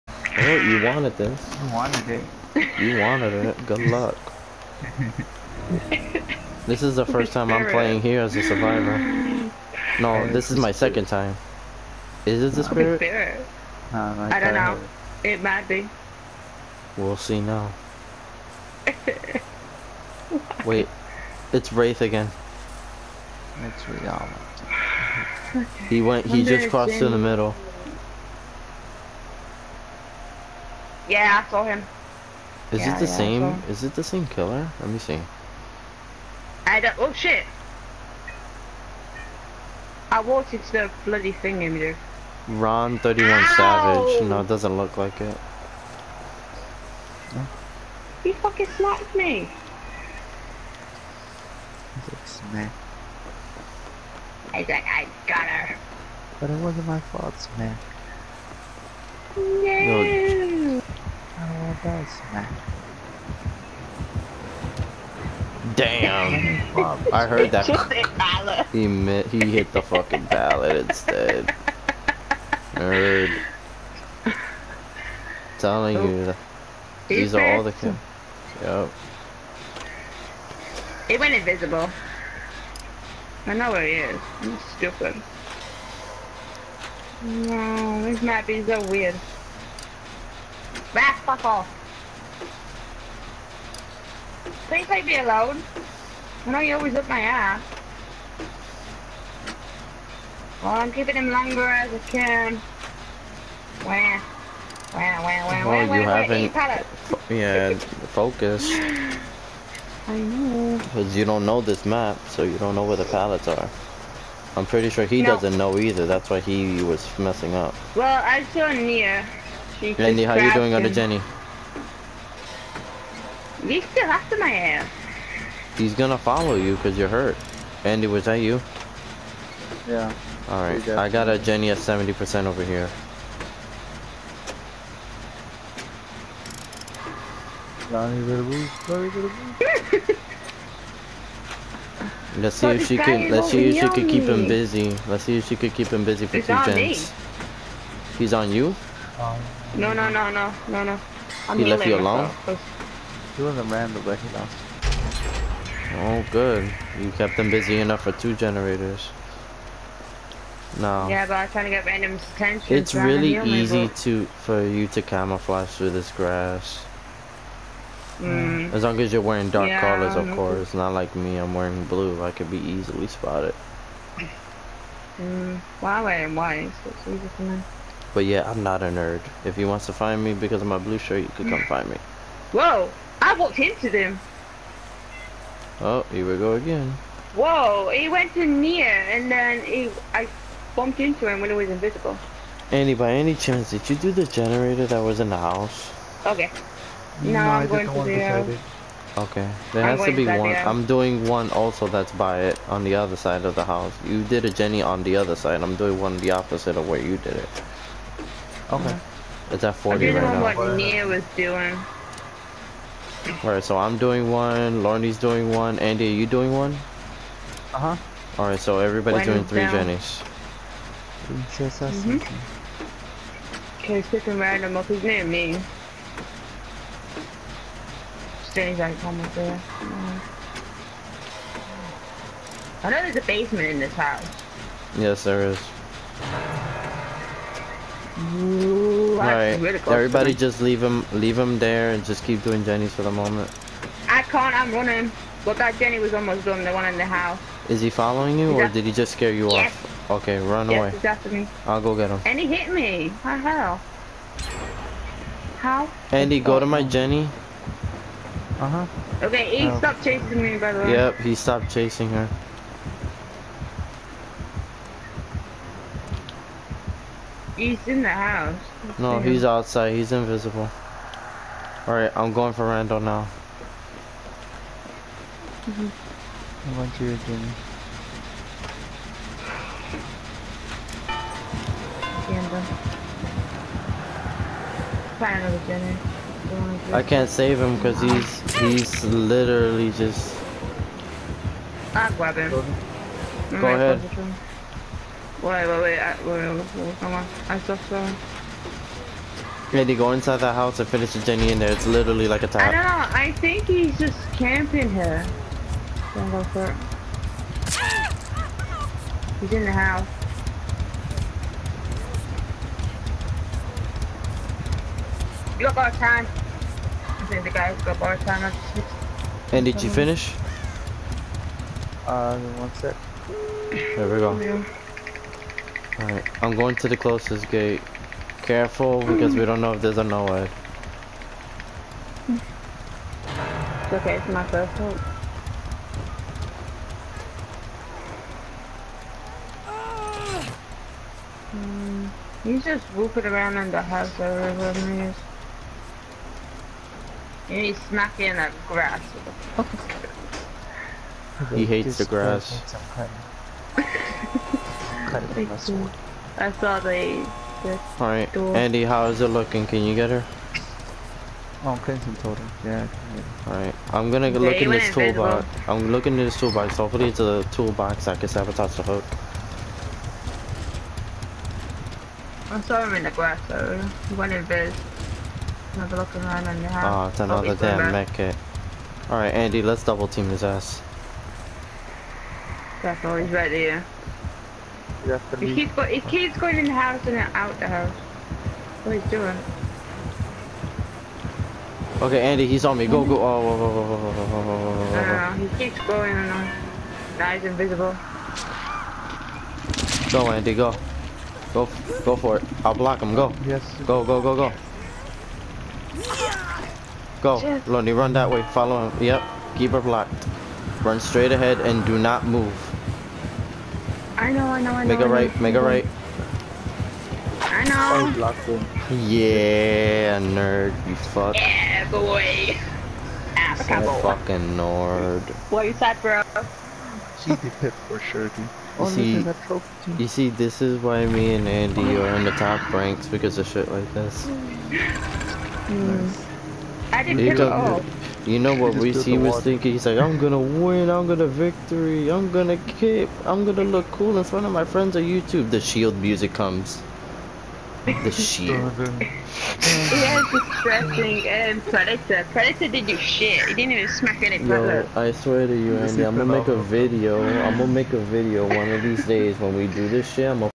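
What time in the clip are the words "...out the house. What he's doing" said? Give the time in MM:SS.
06:27.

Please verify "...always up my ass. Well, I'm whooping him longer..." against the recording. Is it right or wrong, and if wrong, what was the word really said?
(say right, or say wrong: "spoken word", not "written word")
wrong: "keeping", not "whooping".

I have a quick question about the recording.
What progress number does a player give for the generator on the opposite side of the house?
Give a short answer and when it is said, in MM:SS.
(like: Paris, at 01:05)
40, at 03:29.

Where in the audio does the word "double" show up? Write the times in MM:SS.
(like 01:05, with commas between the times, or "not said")
06:19.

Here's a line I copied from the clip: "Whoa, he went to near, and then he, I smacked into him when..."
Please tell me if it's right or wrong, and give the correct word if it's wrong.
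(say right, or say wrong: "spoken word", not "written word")
wrong: "bumped", not "smacked".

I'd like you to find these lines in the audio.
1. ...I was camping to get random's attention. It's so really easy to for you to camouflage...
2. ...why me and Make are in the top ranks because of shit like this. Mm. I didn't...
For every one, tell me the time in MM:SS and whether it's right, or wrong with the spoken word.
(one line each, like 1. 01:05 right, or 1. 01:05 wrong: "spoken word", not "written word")
1. 02:41 wrong: "trying", not "camping"
2. 07:10 wrong: "Andy", not "Make".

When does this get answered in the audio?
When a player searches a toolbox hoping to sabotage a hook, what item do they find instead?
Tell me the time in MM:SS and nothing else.
06:17.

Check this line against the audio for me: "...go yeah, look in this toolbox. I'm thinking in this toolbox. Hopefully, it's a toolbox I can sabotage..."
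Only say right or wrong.
wrong.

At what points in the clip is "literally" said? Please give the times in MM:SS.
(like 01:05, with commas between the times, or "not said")
04:49, 05:01.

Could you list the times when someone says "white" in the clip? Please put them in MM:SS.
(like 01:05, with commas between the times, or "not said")
02:56.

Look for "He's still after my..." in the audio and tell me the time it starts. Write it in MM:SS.
02:03.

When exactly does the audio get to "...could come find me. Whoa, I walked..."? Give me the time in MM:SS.
03:01.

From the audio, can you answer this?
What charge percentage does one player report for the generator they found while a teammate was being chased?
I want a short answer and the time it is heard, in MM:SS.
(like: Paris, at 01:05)
70%, at 02:11.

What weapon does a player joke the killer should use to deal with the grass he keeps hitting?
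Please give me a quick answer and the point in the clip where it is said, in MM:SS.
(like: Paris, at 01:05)
Sword, at 05:55.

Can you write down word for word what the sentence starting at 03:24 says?
You did a Jenny on the other side.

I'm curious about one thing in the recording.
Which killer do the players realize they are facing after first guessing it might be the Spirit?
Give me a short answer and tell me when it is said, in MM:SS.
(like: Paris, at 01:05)
Wraith, at 00:21.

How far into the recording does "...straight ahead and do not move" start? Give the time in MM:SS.
06:50.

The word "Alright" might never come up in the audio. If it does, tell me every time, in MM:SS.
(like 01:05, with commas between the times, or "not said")
02:10, 03:33, 03:38, 04:31, 05:26, 05:57, 06:03, 06:19.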